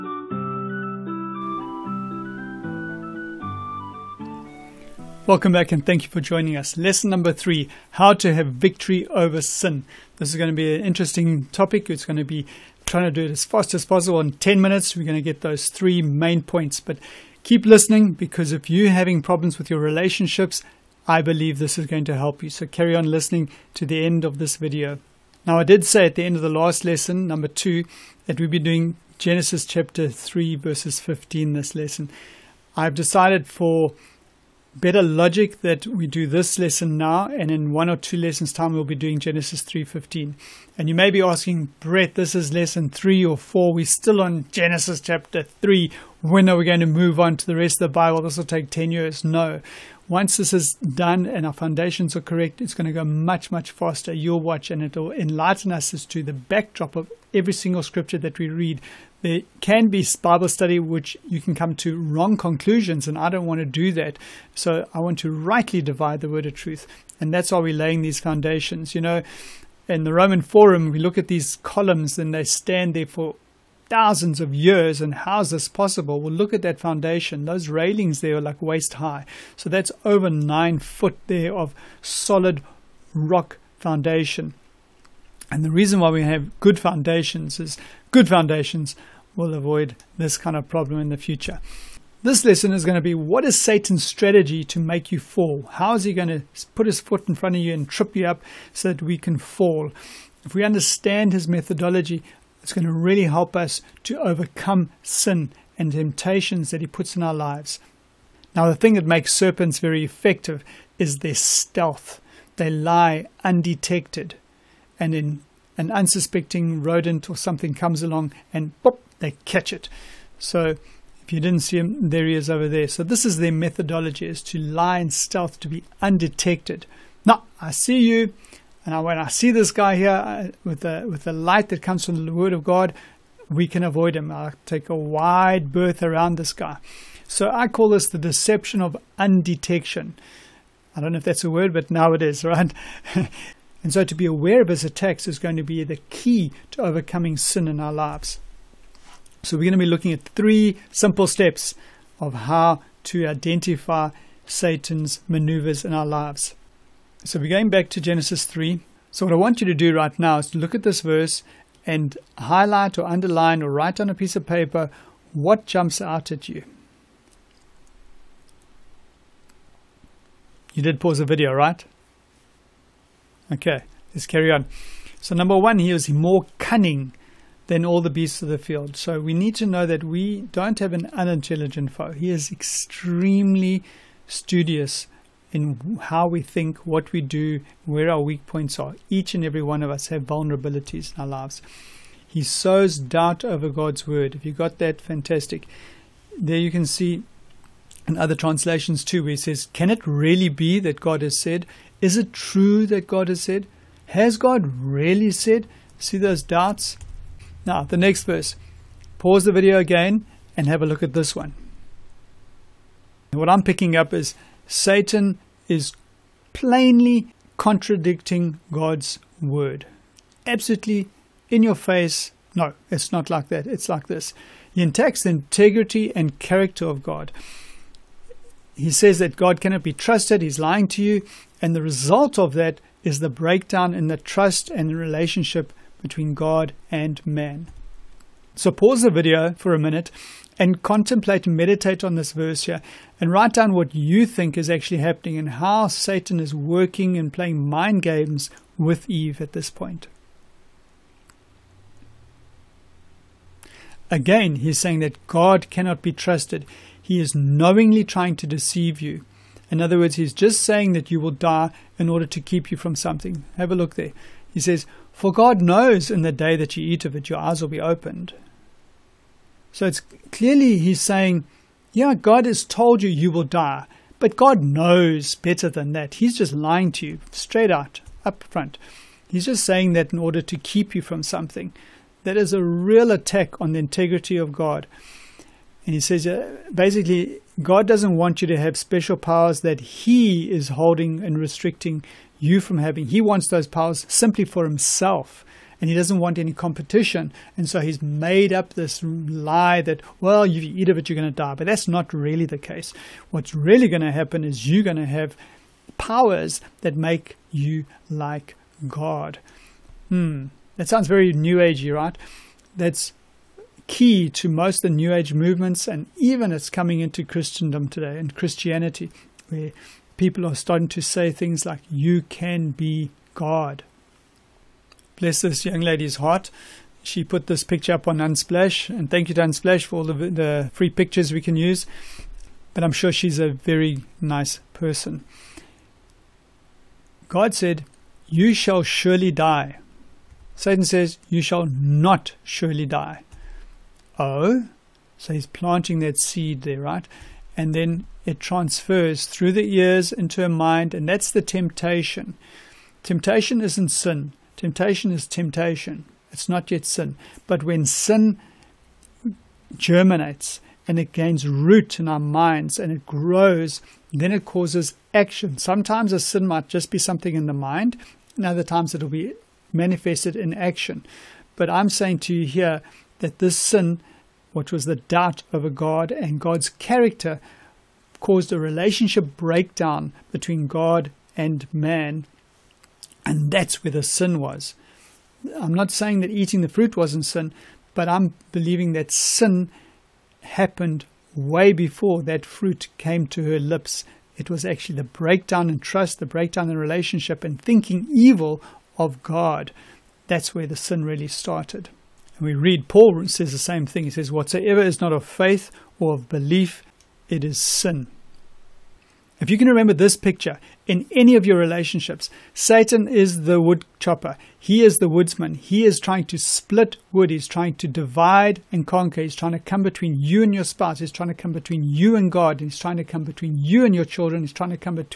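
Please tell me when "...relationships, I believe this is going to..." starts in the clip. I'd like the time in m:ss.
0:19.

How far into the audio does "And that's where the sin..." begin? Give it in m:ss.
6:23.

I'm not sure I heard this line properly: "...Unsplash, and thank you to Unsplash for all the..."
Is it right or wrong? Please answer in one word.
right.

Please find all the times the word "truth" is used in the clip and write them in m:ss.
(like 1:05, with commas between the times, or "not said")
1:06.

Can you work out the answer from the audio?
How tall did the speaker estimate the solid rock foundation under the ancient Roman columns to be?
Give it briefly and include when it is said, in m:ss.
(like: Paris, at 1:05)
over 9 feet, at 1:20.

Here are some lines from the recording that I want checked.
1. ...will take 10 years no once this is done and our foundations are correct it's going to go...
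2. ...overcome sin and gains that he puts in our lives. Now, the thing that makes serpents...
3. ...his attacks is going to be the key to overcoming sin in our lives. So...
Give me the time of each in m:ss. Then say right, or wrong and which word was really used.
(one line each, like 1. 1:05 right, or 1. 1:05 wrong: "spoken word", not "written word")
1. 0:48 right
2. 1:44 wrong: "temptations", not "gains"
3. 2:24 right.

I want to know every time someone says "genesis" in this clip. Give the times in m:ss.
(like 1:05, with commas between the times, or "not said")
0:29, 0:39, 0:44, 2:38.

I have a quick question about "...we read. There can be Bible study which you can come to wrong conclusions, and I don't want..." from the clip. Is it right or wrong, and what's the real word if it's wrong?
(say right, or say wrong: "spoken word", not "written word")
right.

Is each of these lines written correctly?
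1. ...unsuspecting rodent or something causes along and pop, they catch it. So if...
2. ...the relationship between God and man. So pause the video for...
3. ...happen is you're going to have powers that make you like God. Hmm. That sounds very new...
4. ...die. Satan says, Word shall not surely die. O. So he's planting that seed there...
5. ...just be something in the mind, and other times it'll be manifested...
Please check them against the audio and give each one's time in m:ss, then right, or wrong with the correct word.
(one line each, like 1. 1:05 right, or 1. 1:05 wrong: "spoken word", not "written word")
1. 1:55 wrong: "comes", not "causes"
2. 3:54 right
3. 5:04 right
4. 5:39 wrong: "You", not "Word"
5. 6:06 right.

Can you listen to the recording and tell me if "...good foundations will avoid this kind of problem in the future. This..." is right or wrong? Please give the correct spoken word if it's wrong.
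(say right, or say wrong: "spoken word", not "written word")
right.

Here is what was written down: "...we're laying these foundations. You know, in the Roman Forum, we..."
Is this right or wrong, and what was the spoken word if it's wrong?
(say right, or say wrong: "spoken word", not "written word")
right.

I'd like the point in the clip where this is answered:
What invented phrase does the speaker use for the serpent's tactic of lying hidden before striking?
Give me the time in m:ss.
2:18.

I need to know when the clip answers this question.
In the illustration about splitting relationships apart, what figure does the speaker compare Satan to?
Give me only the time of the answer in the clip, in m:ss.
6:53.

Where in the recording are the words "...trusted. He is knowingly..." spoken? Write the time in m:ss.
4:16.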